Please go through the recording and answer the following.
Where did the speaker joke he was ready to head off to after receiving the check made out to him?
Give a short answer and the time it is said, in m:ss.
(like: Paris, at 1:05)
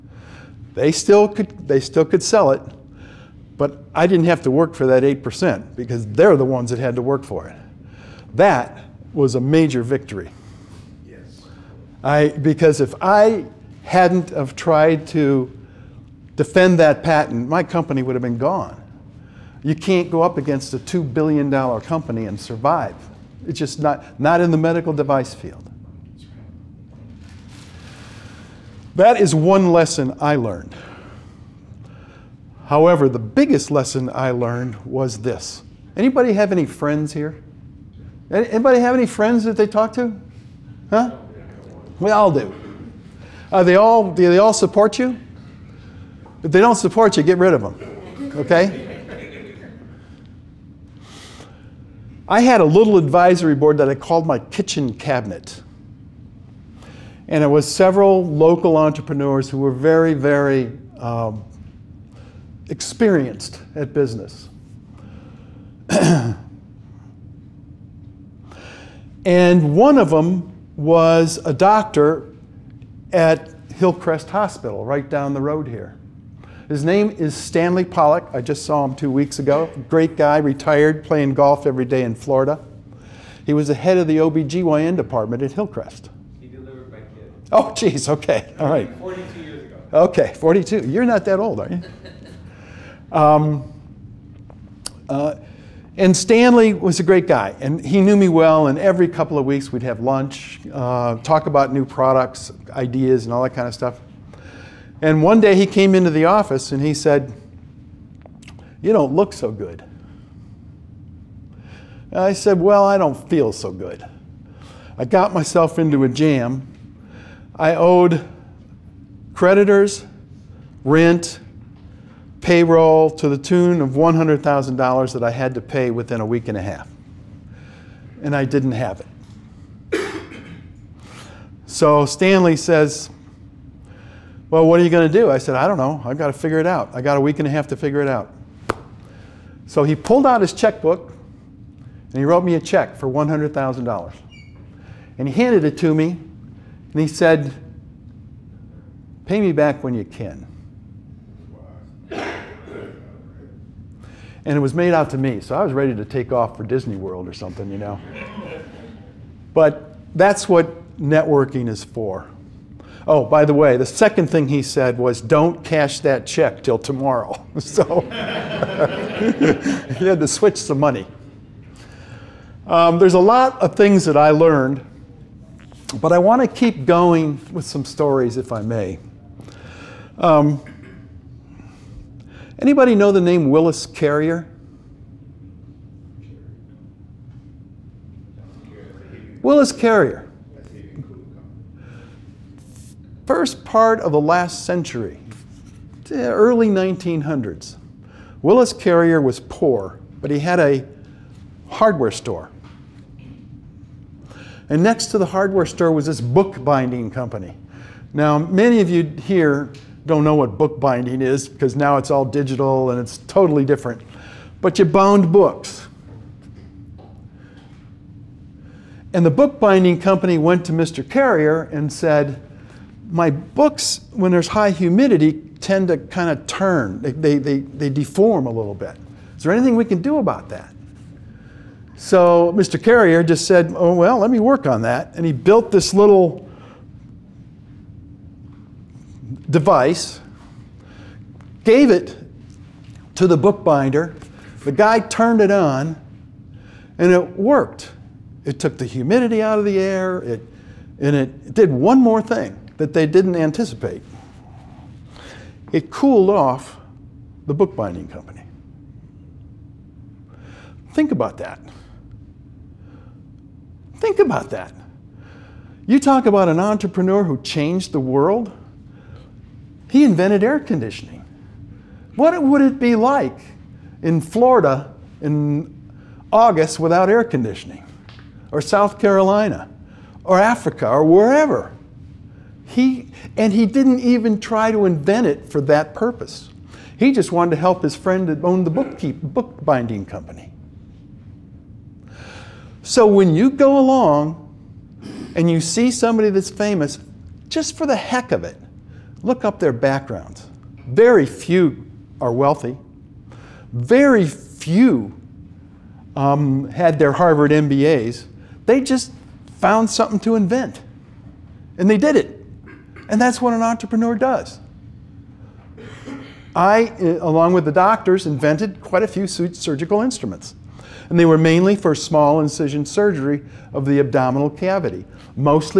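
Disney World, at 2:36.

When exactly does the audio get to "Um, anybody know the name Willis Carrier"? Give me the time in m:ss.
3:00.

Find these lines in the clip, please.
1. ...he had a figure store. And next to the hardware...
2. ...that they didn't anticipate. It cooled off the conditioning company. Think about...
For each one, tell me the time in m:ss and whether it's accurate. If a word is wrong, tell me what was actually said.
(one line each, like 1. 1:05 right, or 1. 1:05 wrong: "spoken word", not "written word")
1. 3:20 wrong: "hardware", not "figure"
2. 4:12 wrong: "bookbinding", not "conditioning".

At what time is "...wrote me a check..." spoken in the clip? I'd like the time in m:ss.
2:22.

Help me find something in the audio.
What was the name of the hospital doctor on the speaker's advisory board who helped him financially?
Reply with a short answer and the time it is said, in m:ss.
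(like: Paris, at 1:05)
Stanley Pollock, at 1:17.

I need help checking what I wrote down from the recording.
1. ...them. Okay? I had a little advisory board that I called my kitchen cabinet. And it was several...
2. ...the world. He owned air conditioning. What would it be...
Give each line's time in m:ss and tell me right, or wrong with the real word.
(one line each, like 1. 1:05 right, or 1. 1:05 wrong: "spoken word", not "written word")
1. 0:47 right
2. 4:27 wrong: "invented", not "owned".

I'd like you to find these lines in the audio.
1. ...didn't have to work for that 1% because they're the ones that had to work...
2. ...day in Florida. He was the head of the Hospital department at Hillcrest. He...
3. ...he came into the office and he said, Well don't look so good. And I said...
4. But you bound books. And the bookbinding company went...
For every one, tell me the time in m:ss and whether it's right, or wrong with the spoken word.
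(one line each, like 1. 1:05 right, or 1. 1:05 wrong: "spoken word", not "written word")
1. 0:04 wrong: "8", not "1"
2. 1:21 wrong: "OBGYN", not "Hospital"
3. 1:45 wrong: "You", not "Well"
4. 3:34 right.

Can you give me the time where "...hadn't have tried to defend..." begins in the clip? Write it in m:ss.
0:13.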